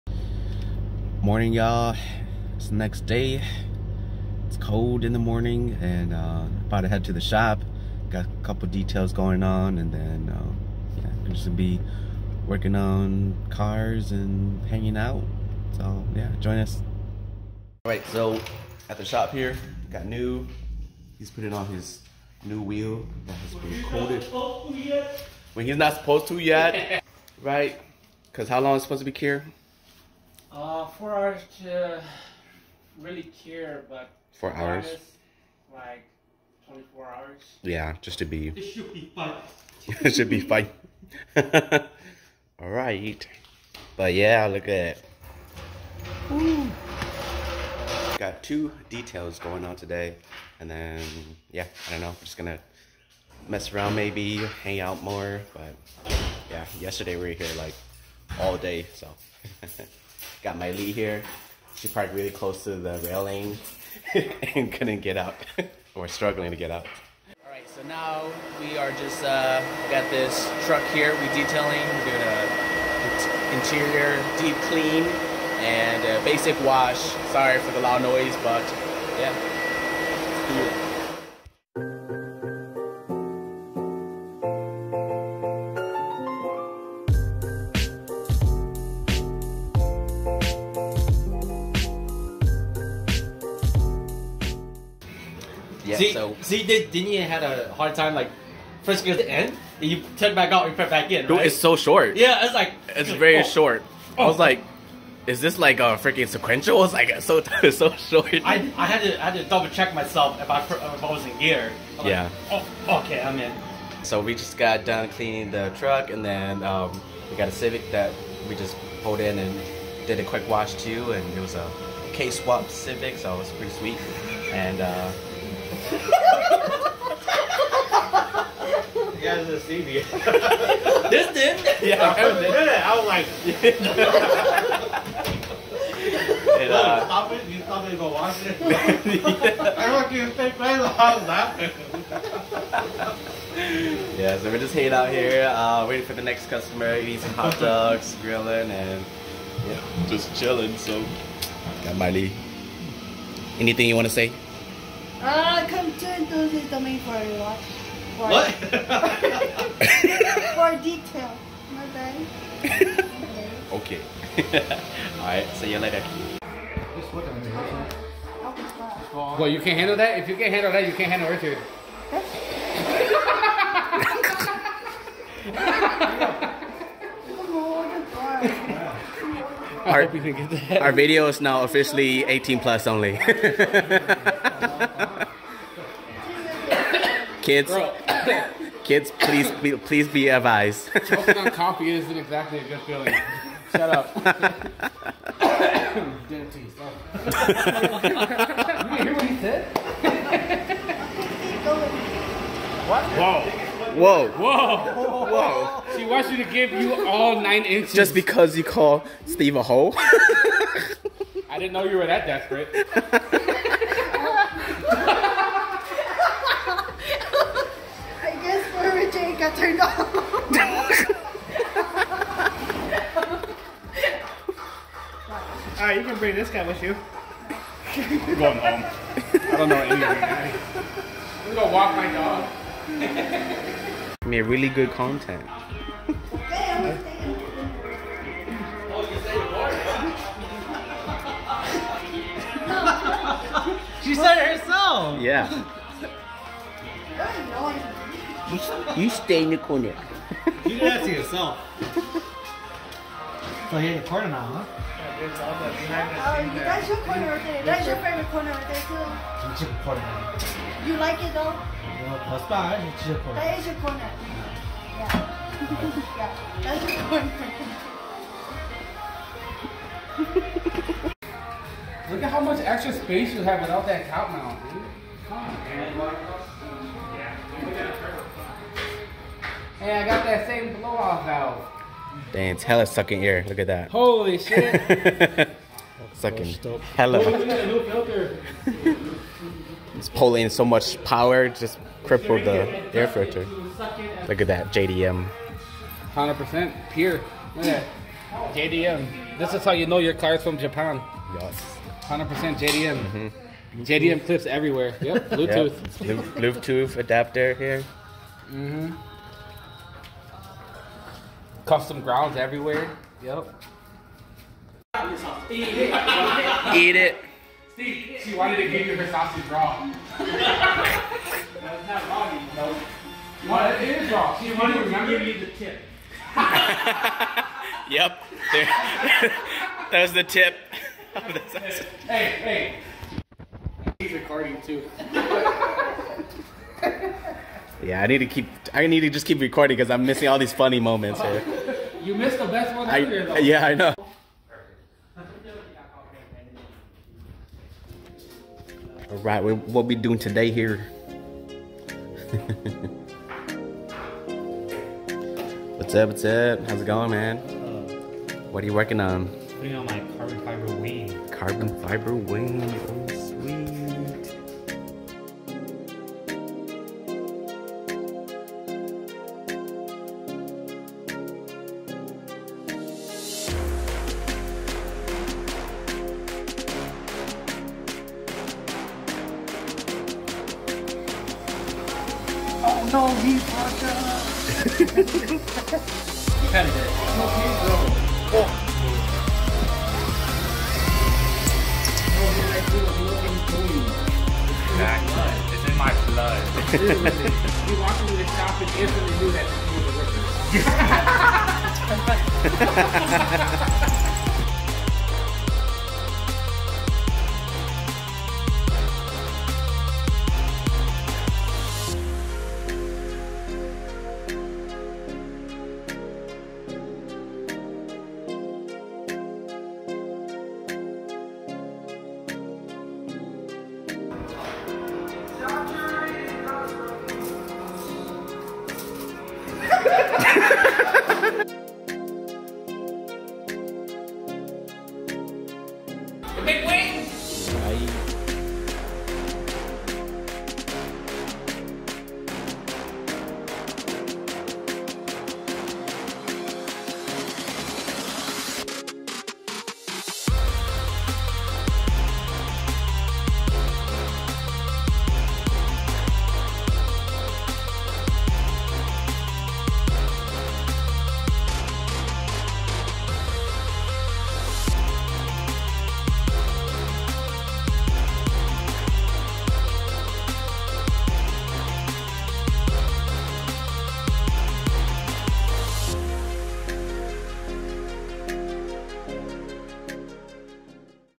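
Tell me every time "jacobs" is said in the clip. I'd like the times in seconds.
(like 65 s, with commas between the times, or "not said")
not said.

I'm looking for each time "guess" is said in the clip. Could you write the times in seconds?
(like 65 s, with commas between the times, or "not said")
218 s.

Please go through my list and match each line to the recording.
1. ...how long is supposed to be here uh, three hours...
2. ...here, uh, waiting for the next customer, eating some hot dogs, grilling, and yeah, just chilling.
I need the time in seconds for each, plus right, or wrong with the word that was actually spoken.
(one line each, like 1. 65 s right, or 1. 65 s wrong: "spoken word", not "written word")
1. 28 s wrong: "four", not "three"
2. 145 s right.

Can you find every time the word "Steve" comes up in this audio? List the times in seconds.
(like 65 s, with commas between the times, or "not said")
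209 s, 317 s.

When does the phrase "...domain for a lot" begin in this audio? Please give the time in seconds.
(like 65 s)
156 s.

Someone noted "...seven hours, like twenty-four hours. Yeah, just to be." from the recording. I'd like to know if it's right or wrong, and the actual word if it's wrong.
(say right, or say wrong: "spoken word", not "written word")
wrong: "four", not "seven".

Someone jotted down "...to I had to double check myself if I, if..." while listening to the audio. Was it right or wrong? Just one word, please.
right.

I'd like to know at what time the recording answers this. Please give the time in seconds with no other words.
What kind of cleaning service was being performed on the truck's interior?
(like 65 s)
74 s.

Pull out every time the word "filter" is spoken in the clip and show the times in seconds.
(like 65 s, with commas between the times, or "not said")
293 s.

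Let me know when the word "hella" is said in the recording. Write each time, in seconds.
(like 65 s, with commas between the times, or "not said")
282 s, 286 s.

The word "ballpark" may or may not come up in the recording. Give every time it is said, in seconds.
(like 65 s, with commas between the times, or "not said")
not said.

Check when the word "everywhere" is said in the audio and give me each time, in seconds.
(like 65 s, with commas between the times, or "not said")
304 s, 312 s.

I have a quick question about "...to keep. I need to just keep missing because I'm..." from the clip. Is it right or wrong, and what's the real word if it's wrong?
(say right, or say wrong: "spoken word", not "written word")
wrong: "recording", not "missing".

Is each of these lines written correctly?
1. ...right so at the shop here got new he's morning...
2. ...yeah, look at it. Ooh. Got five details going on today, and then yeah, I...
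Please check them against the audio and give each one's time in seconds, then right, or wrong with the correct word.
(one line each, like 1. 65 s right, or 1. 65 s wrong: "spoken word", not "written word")
1. 17 s wrong: "putting", not "morning"
2. 44 s wrong: "two", not "five".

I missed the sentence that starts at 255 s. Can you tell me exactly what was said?
Oh, that's your corner right there.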